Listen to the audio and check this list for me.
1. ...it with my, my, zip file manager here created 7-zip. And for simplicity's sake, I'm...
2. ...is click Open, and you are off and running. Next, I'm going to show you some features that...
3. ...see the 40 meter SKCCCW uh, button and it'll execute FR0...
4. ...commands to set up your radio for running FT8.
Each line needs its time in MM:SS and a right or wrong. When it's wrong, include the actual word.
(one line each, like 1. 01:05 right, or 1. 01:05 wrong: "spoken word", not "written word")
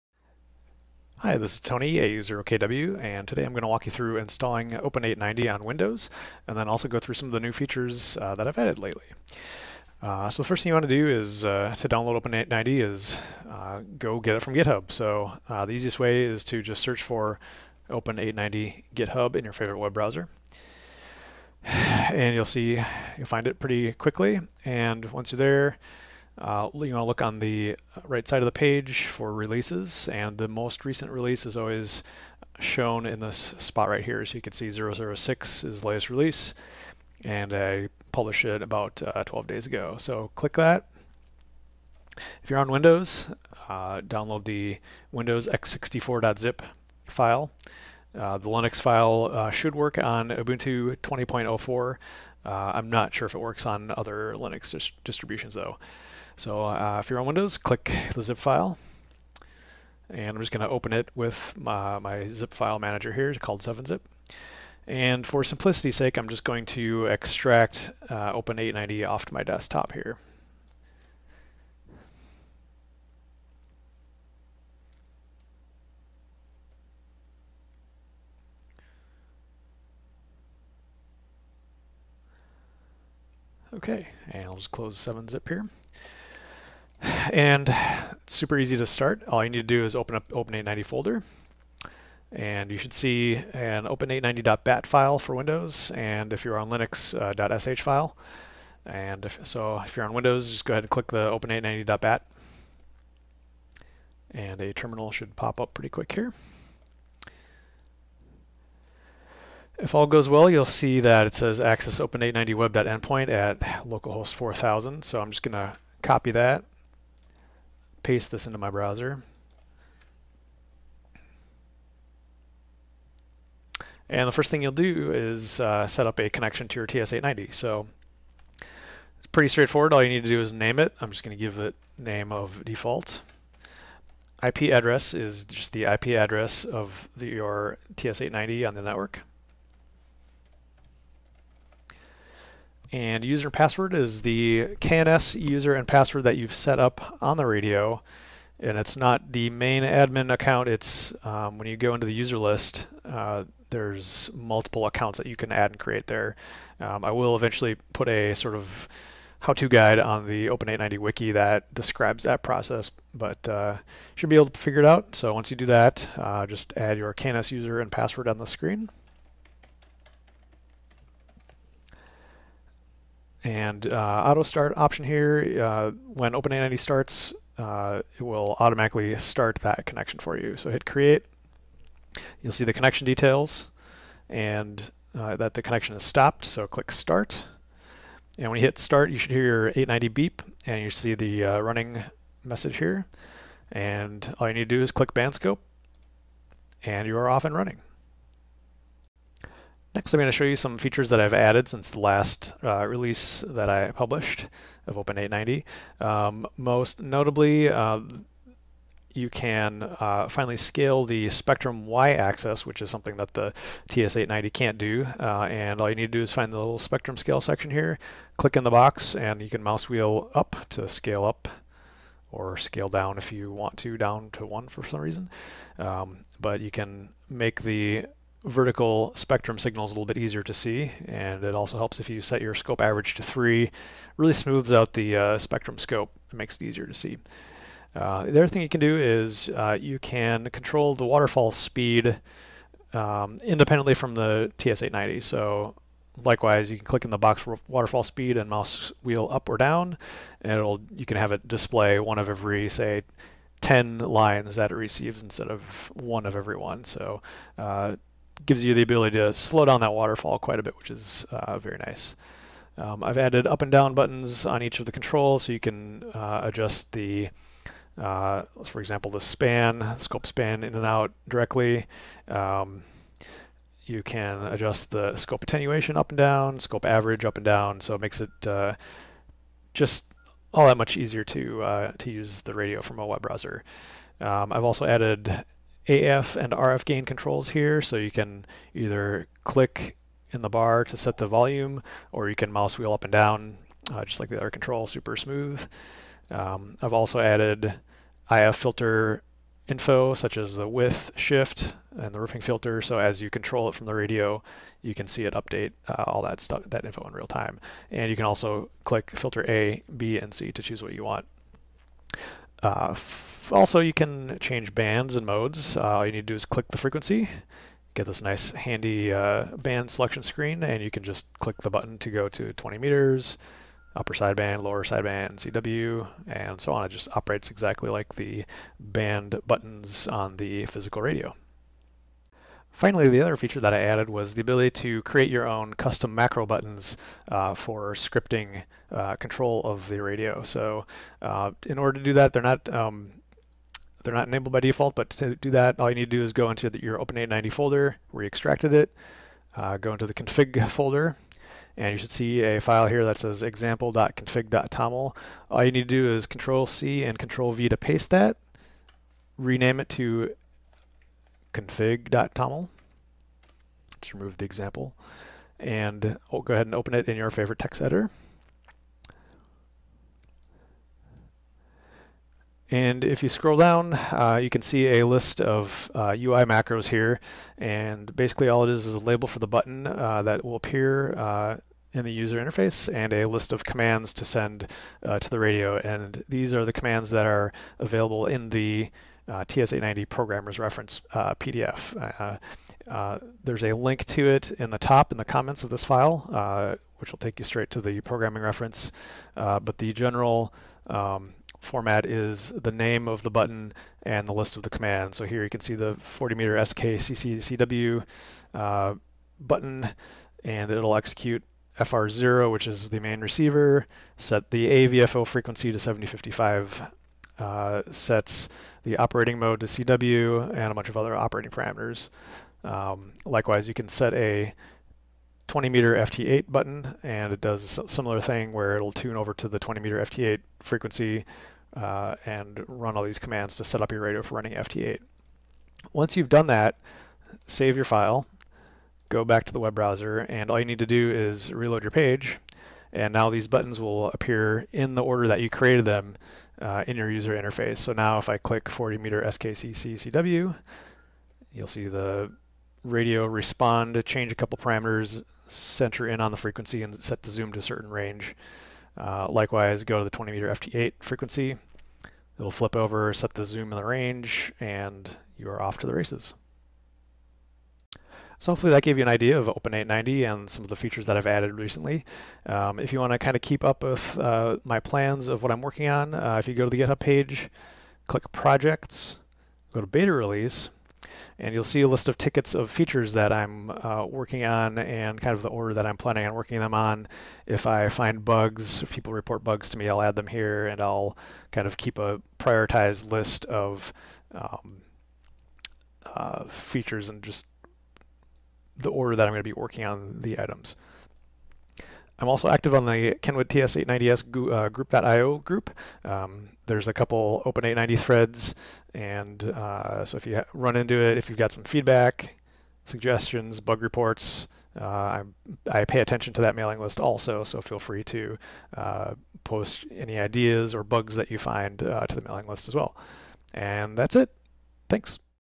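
1. 01:00 wrong: "called", not "created"
2. 03:14 wrong: "Bandscope", not "Open"
3. 06:45 right
4. 07:13 right.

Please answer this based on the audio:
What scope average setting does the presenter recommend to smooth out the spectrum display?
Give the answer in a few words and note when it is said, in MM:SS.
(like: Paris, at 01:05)
3, at 03:53.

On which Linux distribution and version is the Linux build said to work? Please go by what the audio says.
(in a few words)
Ubuntu 20.04.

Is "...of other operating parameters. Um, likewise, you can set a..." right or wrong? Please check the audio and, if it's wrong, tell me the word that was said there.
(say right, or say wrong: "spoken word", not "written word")
right.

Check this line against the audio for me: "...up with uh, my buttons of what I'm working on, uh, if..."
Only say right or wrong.
wrong.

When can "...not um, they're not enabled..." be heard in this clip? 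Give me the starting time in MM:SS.
05:42.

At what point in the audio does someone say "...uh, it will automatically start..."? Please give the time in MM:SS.
02:57.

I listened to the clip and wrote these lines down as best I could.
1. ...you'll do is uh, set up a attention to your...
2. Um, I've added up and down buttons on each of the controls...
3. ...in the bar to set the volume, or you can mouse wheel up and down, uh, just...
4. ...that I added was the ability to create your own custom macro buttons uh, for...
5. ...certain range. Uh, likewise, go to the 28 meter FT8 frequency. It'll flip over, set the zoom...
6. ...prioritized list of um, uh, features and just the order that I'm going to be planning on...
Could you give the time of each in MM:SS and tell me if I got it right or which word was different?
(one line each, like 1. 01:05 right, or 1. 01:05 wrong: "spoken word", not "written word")
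1. 02:04 wrong: "connection", not "attention"
2. 04:22 right
3. 04:50 right
4. 05:33 right
5. 07:37 wrong: "20", not "28"
6. 08:12 wrong: "working", not "planning".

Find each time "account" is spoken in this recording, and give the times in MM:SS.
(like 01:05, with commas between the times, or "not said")
02:30, 02:34.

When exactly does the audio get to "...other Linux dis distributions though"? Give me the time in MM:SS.
00:53.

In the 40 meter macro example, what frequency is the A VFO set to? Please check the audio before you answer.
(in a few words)
7055.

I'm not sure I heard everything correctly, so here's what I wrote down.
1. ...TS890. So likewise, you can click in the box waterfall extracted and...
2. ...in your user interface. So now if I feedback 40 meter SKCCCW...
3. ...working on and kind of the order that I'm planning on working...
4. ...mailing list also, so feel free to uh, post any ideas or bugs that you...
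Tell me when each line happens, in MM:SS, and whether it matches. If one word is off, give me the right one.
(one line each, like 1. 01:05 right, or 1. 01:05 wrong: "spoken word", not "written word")
1. 04:04 wrong: "speed", not "extracted"
2. 07:26 wrong: "click", not "feedback"
3. 08:04 right
4. 08:36 right.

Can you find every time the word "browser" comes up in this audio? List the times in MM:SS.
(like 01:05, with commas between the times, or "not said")
00:19, 01:58, 04:43, 07:19.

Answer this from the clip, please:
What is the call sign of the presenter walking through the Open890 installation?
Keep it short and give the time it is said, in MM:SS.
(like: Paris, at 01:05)
A0KW, at 00:01.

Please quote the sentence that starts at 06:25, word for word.
And these are the commands that are available in the uh, TS890 programmer's reference PDF.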